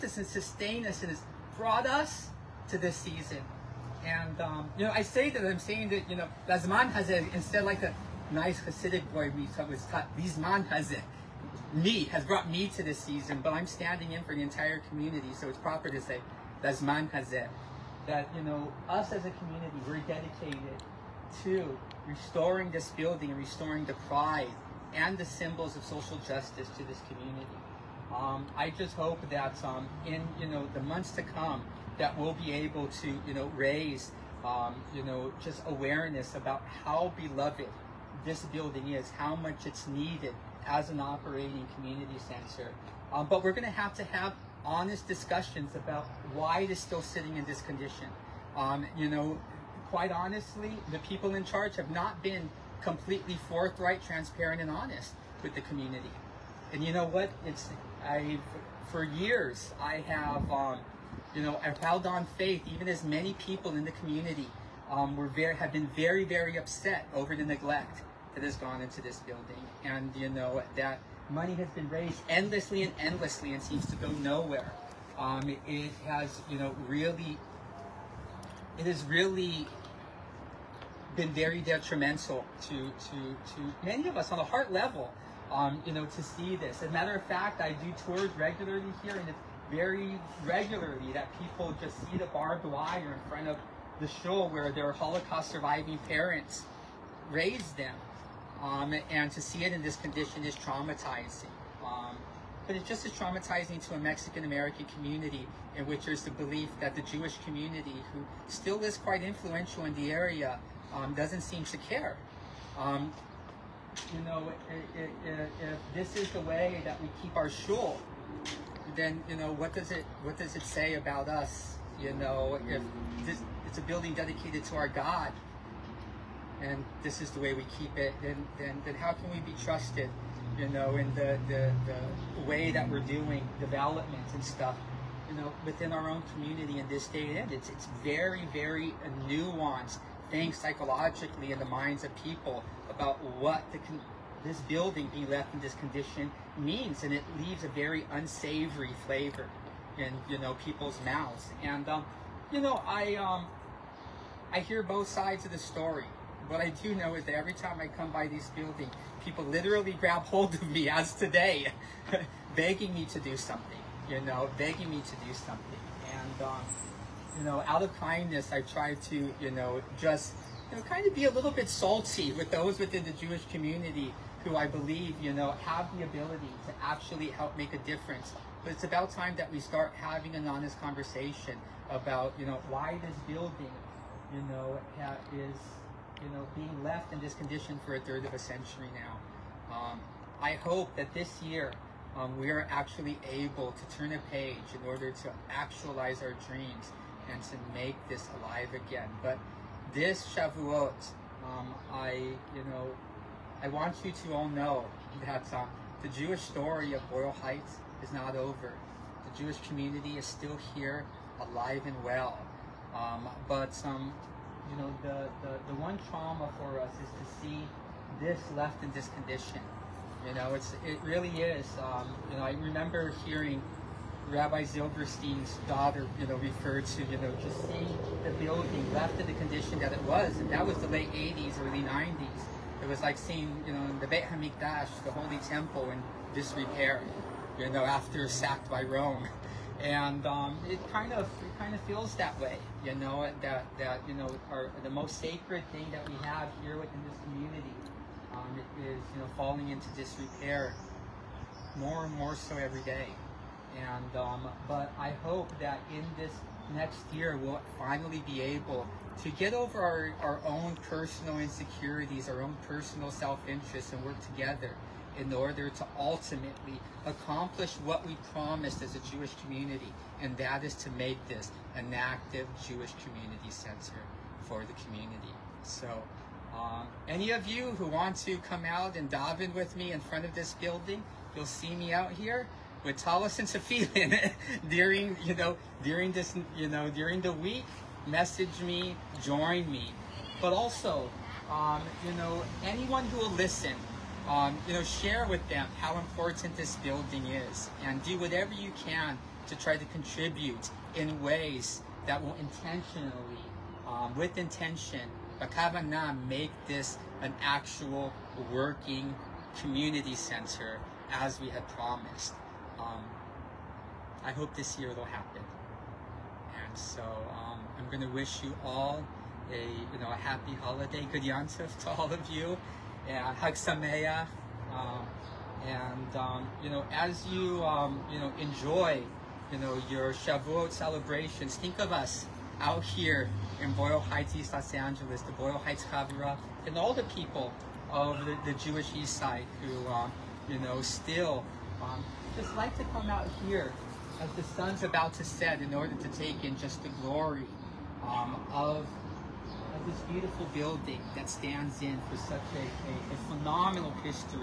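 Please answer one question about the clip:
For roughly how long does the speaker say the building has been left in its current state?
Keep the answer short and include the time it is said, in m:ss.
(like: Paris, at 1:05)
a third of a century, at 3:07.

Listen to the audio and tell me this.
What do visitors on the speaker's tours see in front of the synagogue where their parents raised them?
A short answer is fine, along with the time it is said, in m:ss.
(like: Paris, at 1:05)
barbed wire, at 1:32.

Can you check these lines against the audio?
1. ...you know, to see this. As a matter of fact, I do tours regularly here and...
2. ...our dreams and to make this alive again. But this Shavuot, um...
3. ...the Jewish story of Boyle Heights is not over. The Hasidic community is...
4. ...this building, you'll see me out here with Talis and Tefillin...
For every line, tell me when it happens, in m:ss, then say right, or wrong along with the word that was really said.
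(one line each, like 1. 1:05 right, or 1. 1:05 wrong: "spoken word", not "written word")
1. 1:25 right
2. 3:16 right
3. 3:26 wrong: "Jewish", not "Hasidic"
4. 4:40 right.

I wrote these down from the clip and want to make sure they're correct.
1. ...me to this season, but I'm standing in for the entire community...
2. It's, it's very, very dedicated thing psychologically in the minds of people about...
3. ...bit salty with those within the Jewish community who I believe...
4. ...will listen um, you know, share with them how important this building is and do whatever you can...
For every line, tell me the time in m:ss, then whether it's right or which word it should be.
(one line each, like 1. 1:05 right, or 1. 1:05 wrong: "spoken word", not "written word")
1. 0:12 right
2. 2:17 wrong: "nuanced", not "dedicated"
3. 2:51 right
4. 4:53 right.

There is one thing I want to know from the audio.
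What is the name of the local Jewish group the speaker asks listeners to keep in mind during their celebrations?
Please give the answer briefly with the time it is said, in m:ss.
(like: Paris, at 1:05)
Boyle Heights Chavurah, at 5:35.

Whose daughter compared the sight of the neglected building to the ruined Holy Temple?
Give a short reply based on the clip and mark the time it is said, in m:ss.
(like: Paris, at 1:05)
Rabbi Zilberstein, at 3:44.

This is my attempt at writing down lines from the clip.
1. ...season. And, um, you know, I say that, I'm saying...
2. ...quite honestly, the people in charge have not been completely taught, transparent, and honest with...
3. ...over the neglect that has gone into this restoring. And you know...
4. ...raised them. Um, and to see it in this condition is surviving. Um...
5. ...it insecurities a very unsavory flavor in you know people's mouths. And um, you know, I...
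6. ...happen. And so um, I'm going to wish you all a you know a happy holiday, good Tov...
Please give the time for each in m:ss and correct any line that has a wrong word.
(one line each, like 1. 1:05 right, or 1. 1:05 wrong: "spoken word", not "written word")
1. 0:02 right
2. 0:49 wrong: "forthright", not "taught"
3. 1:07 wrong: "building", not "restoring"
4. 1:37 wrong: "traumatizing", not "surviving"
5. 2:27 wrong: "leaves", not "insecurities"
6. 5:15 right.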